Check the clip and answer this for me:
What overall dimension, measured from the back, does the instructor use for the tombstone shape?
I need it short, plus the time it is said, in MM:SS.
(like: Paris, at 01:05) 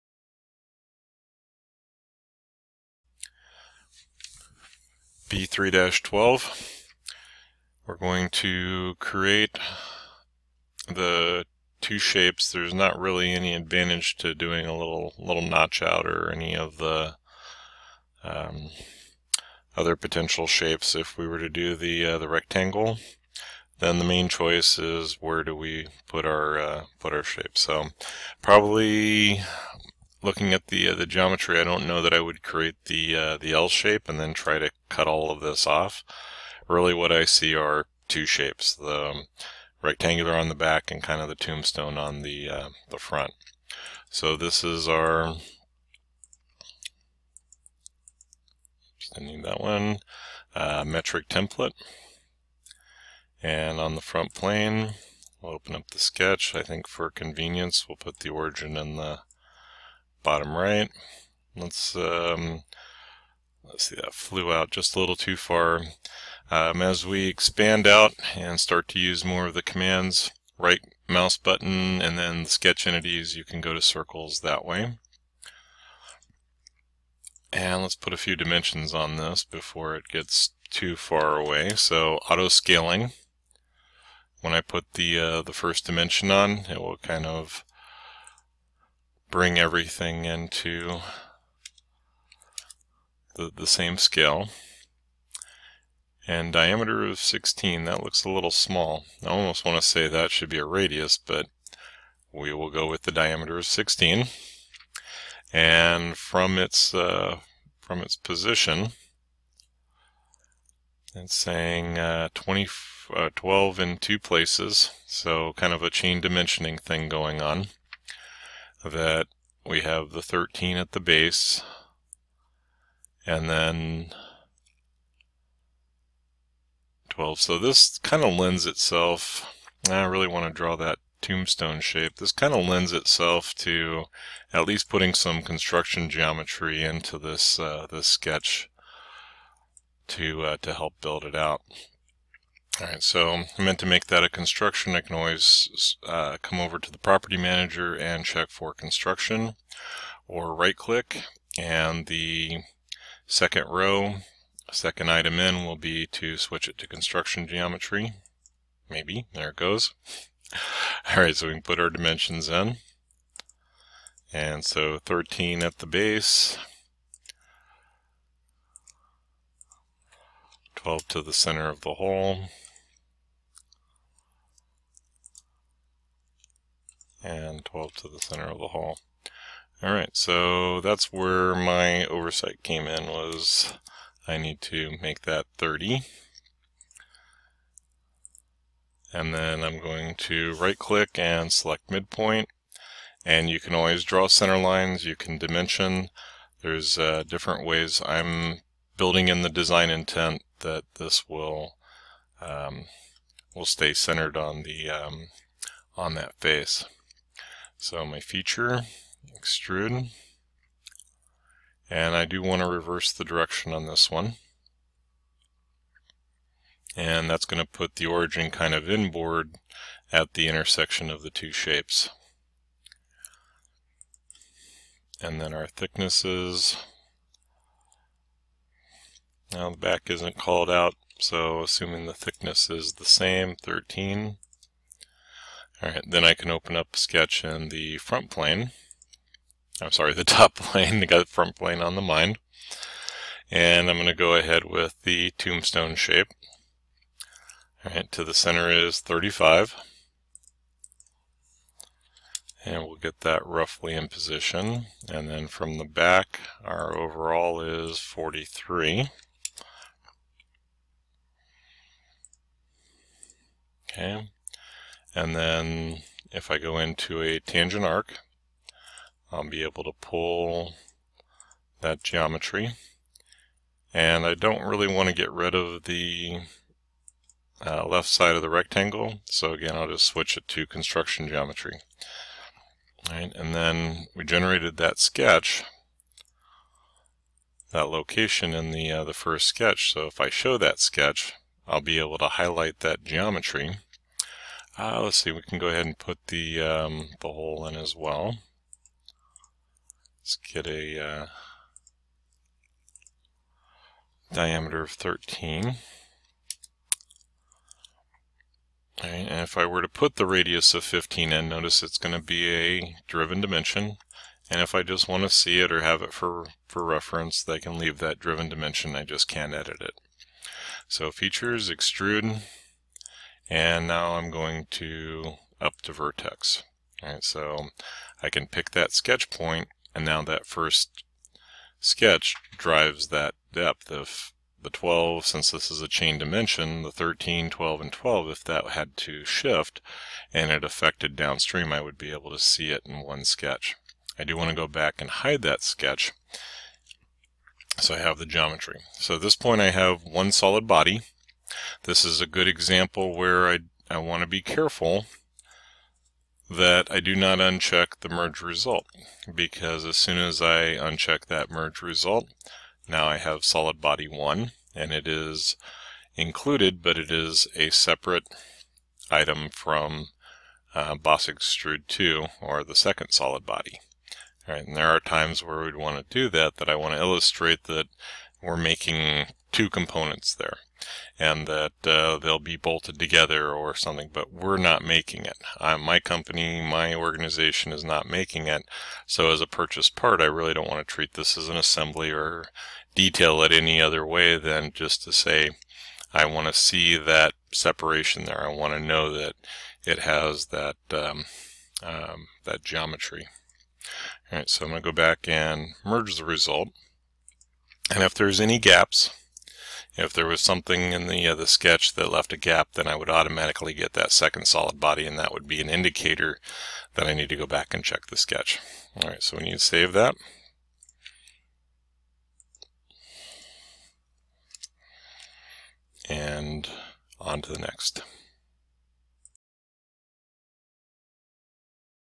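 43, at 04:16.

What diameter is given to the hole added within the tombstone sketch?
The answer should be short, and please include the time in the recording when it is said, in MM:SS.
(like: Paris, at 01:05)
13, at 05:04.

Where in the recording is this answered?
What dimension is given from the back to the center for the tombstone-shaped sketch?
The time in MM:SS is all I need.
04:08.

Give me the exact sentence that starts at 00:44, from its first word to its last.
So this is our, I need that one, uh, metric template.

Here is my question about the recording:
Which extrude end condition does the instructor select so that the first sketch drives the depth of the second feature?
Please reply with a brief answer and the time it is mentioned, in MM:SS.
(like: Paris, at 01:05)
Up to vertex, at 05:25.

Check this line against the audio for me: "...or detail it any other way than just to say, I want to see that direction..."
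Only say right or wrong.
wrong.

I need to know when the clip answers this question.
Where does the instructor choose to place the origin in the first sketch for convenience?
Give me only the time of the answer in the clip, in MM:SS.
01:00.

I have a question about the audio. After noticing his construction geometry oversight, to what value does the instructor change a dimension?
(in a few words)
30.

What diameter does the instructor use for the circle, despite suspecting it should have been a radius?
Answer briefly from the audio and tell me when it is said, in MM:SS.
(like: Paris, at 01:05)
16, at 01:36.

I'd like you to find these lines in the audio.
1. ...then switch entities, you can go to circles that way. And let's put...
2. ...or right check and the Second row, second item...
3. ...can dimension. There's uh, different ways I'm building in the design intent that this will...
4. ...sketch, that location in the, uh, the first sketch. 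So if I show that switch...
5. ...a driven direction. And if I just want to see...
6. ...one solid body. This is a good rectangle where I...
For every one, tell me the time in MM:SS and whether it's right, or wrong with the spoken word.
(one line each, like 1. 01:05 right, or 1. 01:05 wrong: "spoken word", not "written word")
1. 01:12 wrong: "sketch", not "switch"
2. 02:30 wrong: "click", not "check"
3. 03:15 right
4. 04:44 wrong: "sketch", not "switch"
5. 05:12 wrong: "dimension", not "direction"
6. 05:50 wrong: "example", not "rectangle".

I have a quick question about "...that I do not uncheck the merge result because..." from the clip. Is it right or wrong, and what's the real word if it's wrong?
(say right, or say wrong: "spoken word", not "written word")
right.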